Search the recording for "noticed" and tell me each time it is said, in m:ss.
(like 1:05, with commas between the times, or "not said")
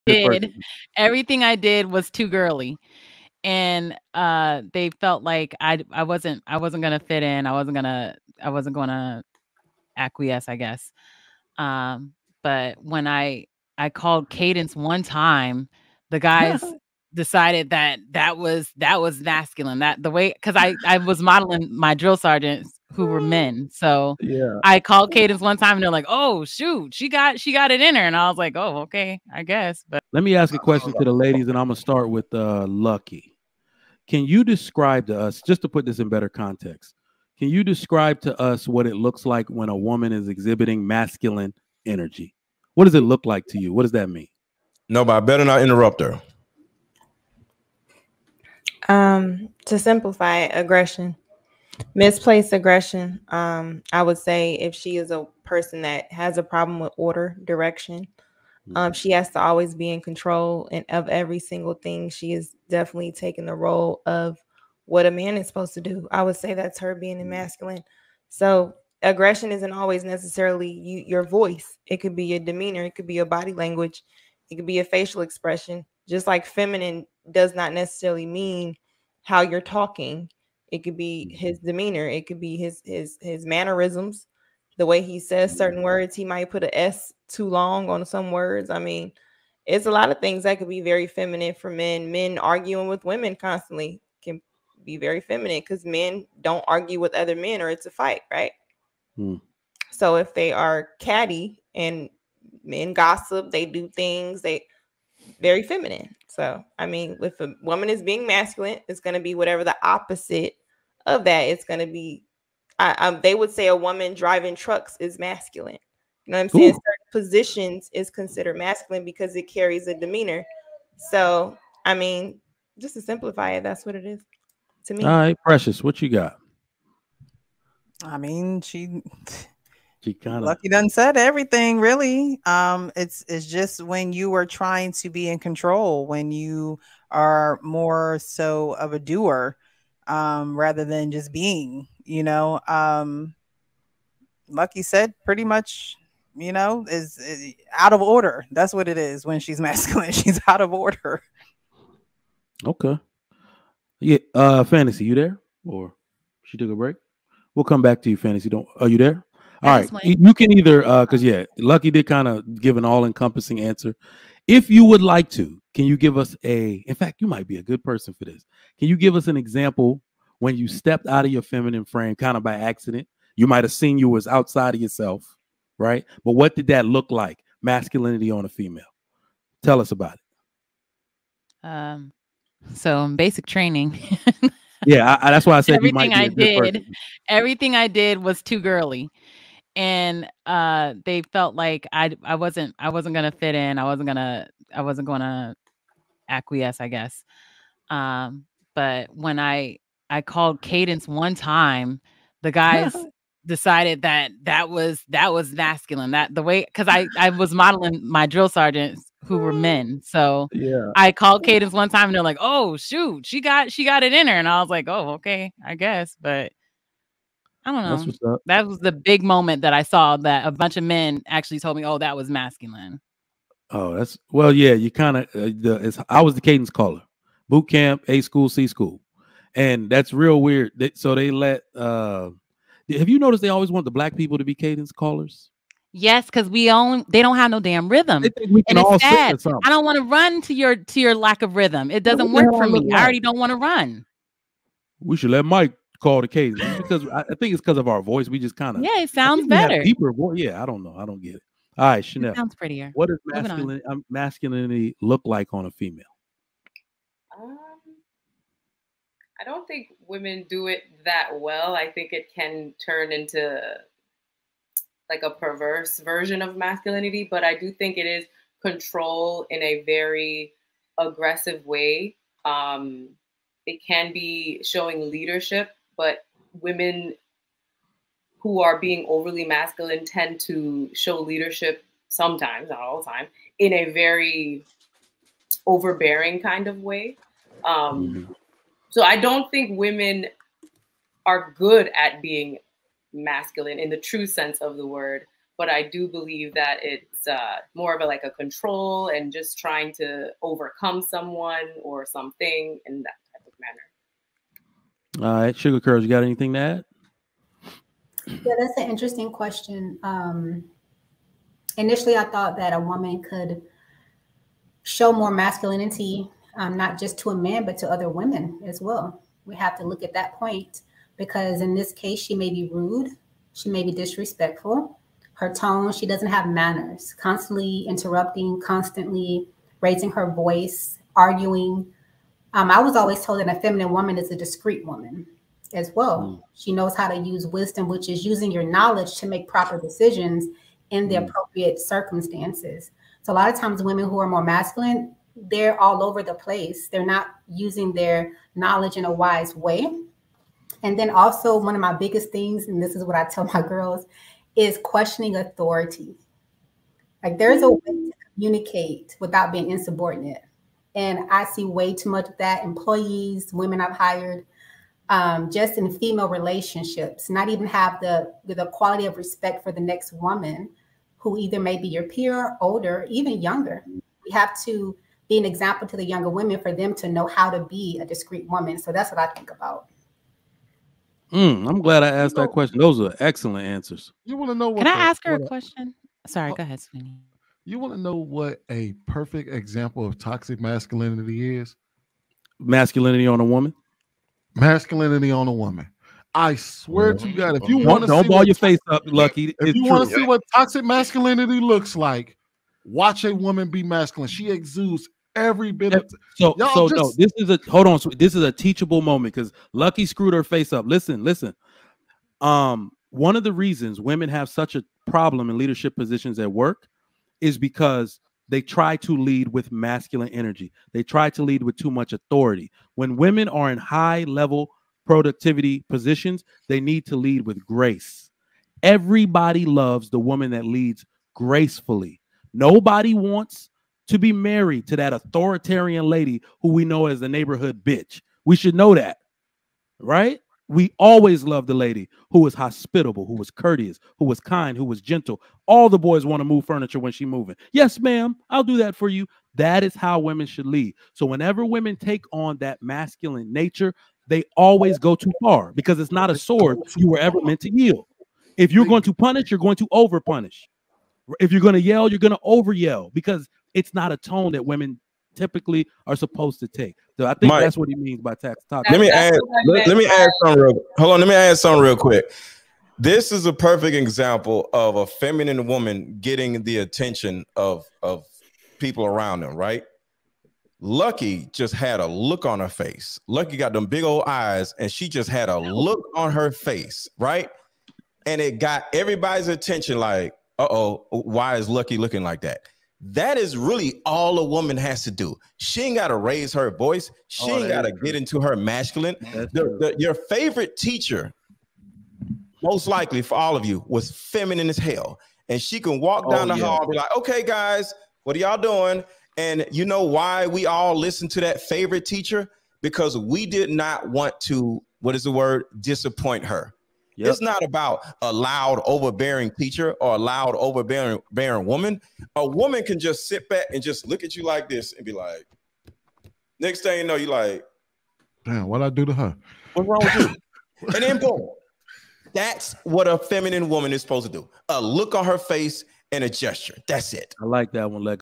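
3:53.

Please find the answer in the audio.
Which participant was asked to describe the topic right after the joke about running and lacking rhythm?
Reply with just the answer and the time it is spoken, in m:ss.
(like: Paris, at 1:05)
Chanel, at 4:12.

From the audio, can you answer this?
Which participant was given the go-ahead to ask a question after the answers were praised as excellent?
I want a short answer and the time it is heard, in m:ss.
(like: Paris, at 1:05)
Sweeney, at 6:26.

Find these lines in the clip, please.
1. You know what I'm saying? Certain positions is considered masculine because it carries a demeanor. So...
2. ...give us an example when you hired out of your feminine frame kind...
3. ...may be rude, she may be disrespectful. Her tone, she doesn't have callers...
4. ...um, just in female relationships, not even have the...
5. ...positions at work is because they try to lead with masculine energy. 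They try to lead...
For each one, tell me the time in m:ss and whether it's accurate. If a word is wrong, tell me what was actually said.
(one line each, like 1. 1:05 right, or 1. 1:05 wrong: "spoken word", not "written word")
1. 1:56 right
2. 2:48 wrong: "stepped", not "hired"
3. 5:22 wrong: "manners", not "callers"
4. 6:05 right
5. 6:55 right.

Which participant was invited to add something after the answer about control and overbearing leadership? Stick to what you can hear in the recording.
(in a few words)
Sugar Curls.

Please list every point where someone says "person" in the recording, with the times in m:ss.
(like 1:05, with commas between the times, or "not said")
0:55, 2:47.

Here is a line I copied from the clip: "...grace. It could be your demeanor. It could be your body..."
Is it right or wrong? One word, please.
wrong.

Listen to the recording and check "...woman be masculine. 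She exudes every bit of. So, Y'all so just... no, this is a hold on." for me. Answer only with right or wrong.
right.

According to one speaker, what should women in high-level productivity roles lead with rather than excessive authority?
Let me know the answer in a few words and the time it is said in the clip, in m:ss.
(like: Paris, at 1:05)
Grace, at 7:07.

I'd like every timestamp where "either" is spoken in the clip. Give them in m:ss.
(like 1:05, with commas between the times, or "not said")
2:40, 6:11.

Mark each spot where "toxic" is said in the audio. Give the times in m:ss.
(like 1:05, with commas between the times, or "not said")
6:30, 6:40.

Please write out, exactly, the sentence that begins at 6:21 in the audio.
Mm, I'm glad I asked that question.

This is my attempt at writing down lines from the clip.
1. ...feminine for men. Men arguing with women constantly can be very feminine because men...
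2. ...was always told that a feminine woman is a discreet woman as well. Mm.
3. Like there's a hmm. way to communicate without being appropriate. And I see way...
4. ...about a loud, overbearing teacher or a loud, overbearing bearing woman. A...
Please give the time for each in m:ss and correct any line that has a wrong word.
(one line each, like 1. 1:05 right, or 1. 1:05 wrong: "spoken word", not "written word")
1. 1:31 right
2. 5:32 right
3. 5:57 wrong: "insubordinate", not "appropriate"
4. 8:37 right.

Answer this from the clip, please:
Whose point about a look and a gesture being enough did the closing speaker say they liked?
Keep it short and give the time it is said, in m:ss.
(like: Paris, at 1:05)
Lex, at 8:58.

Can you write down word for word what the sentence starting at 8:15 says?
She ain't got to raise her voice.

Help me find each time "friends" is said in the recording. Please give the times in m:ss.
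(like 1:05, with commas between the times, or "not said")
not said.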